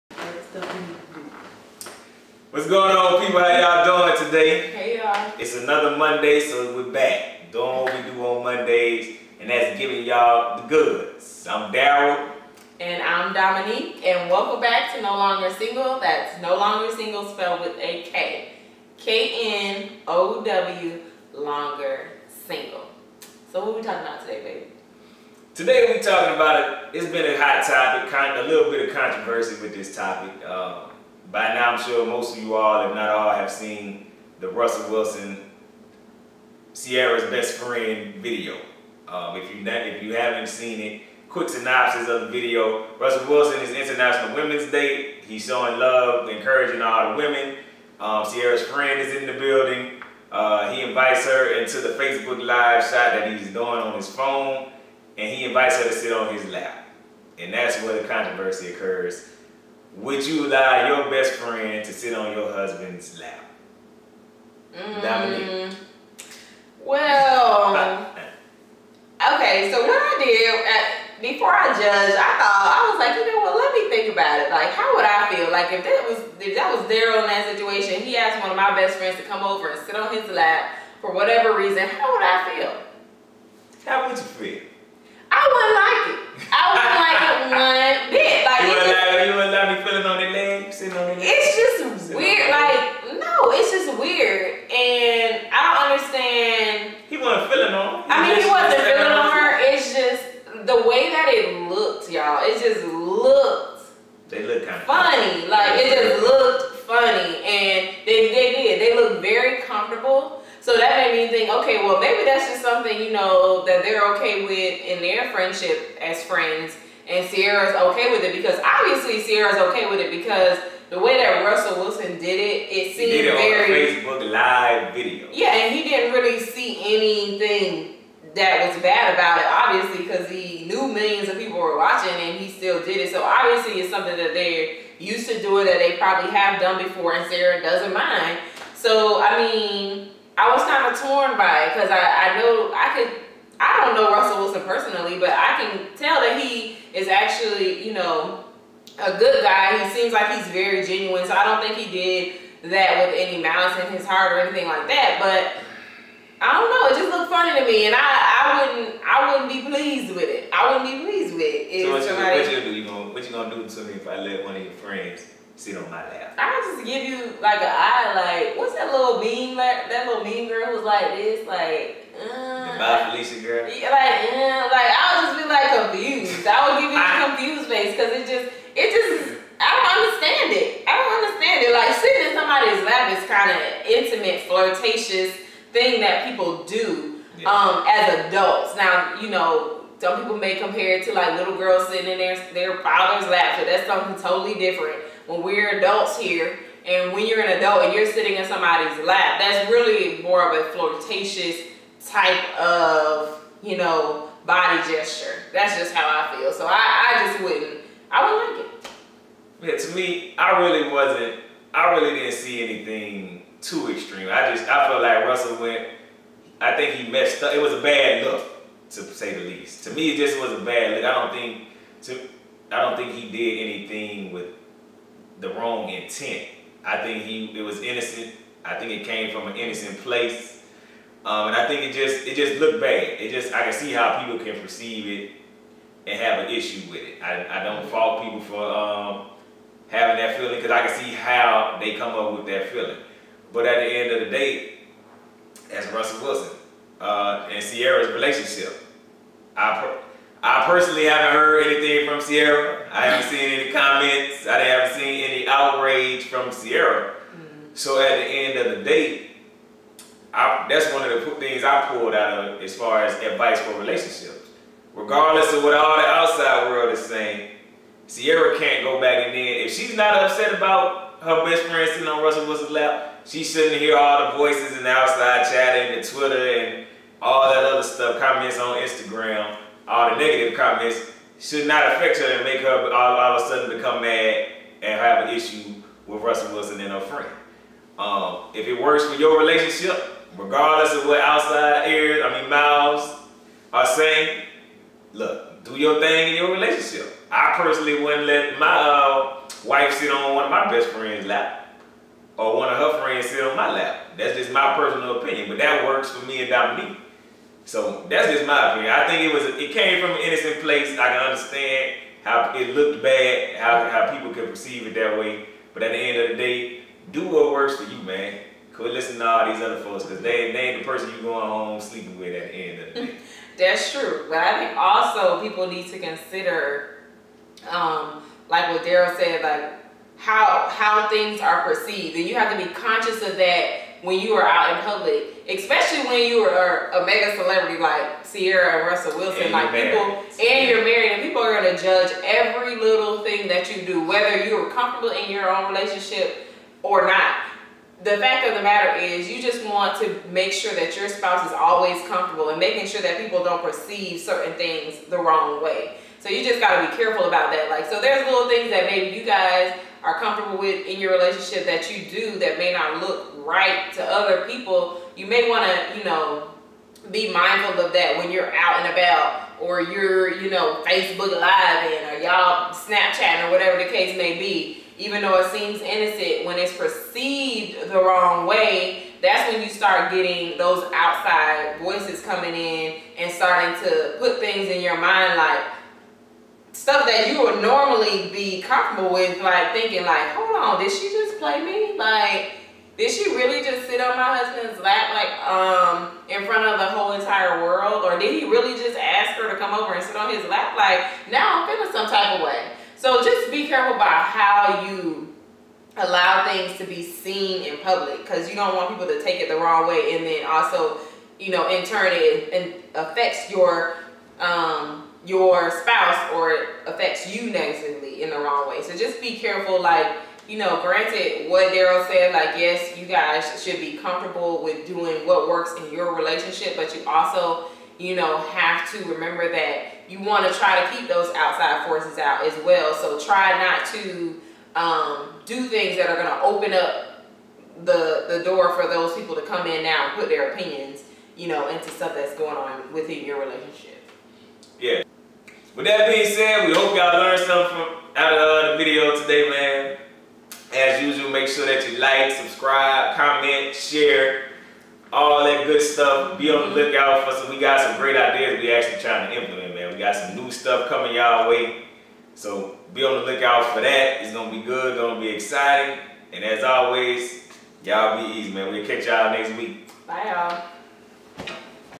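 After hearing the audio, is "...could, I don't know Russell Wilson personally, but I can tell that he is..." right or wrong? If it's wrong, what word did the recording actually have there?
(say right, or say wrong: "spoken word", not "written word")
right.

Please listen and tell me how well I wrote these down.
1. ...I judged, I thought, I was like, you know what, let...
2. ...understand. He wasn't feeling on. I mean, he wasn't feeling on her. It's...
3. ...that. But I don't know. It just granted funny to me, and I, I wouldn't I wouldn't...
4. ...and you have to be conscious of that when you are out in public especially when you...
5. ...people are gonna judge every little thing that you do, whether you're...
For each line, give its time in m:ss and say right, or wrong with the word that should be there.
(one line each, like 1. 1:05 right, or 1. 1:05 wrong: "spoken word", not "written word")
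1. 1:11 right
2. 1:35 right
3. 2:34 wrong: "looked", not "granted"
4. 5:32 right
5. 5:41 right.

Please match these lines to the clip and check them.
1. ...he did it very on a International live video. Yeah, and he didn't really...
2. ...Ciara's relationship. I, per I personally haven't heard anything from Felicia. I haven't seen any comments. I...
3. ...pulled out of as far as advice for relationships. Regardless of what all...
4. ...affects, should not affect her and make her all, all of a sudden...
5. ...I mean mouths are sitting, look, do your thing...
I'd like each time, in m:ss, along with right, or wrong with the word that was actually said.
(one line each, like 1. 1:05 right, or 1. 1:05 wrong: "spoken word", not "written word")
1. 2:03 wrong: "Facebook", not "International"
2. 4:07 wrong: "Ciara", not "Felicia"
3. 4:21 right
4. 4:40 wrong: "comments", not "affects"
5. 4:52 wrong: "saying", not "sitting".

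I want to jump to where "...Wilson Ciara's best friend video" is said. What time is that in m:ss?
0:34.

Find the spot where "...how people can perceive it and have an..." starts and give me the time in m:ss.
3:53.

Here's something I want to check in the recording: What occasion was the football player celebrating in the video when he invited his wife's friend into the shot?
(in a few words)
International Women's Day.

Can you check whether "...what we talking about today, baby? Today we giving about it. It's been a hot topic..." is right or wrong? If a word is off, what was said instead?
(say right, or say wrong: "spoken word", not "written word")
wrong: "talking", not "giving".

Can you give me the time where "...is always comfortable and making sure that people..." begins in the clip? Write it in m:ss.
5:51.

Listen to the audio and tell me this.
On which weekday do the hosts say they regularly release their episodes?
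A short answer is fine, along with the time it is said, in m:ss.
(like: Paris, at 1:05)
Monday, at 0:05.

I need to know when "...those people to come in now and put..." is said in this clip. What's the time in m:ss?
7:18.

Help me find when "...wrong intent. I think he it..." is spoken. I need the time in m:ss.
3:45.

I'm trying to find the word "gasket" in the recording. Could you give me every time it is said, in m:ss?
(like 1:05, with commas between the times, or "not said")
not said.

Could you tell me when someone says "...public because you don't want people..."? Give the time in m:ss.
6:47.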